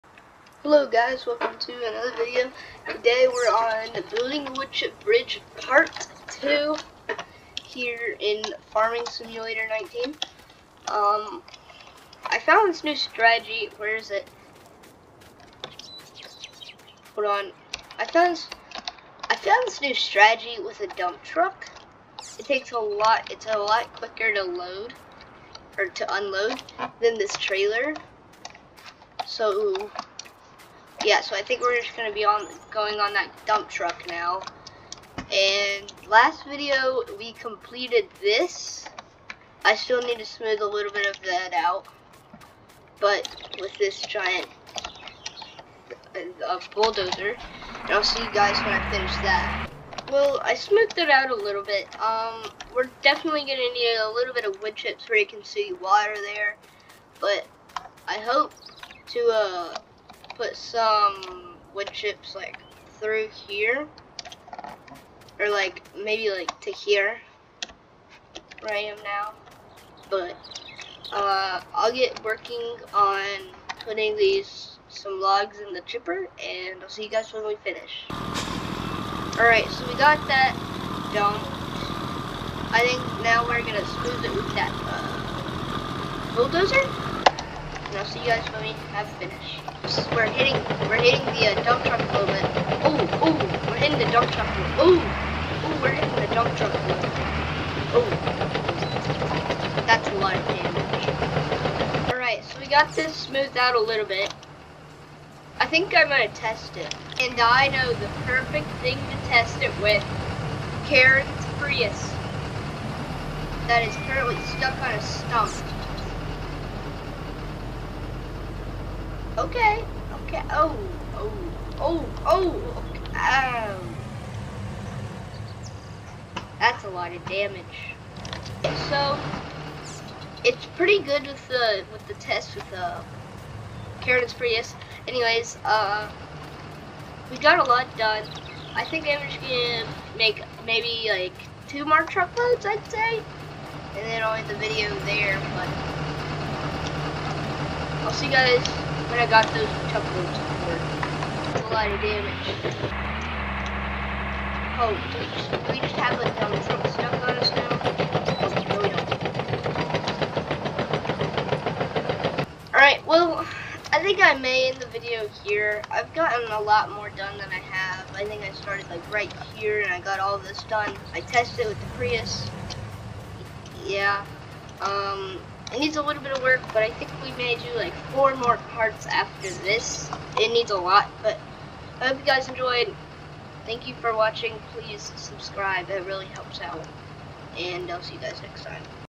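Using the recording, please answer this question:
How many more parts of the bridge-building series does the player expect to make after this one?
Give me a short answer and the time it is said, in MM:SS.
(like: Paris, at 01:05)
4, at 02:58.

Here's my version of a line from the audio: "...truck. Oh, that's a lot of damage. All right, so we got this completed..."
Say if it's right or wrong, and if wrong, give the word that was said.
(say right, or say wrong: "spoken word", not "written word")
wrong: "smoothed", not "completed".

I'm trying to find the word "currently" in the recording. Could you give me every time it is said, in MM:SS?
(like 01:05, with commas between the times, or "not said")
01:54.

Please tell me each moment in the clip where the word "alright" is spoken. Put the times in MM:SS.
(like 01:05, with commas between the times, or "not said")
01:18, 02:42.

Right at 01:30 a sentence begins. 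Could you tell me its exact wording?
We're hitting, we're hitting the uh, dump truck a little bit.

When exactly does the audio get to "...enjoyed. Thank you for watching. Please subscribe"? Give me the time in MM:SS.
03:02.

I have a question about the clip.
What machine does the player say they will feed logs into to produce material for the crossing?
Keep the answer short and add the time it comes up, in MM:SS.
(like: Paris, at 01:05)
The chipper, at 01:15.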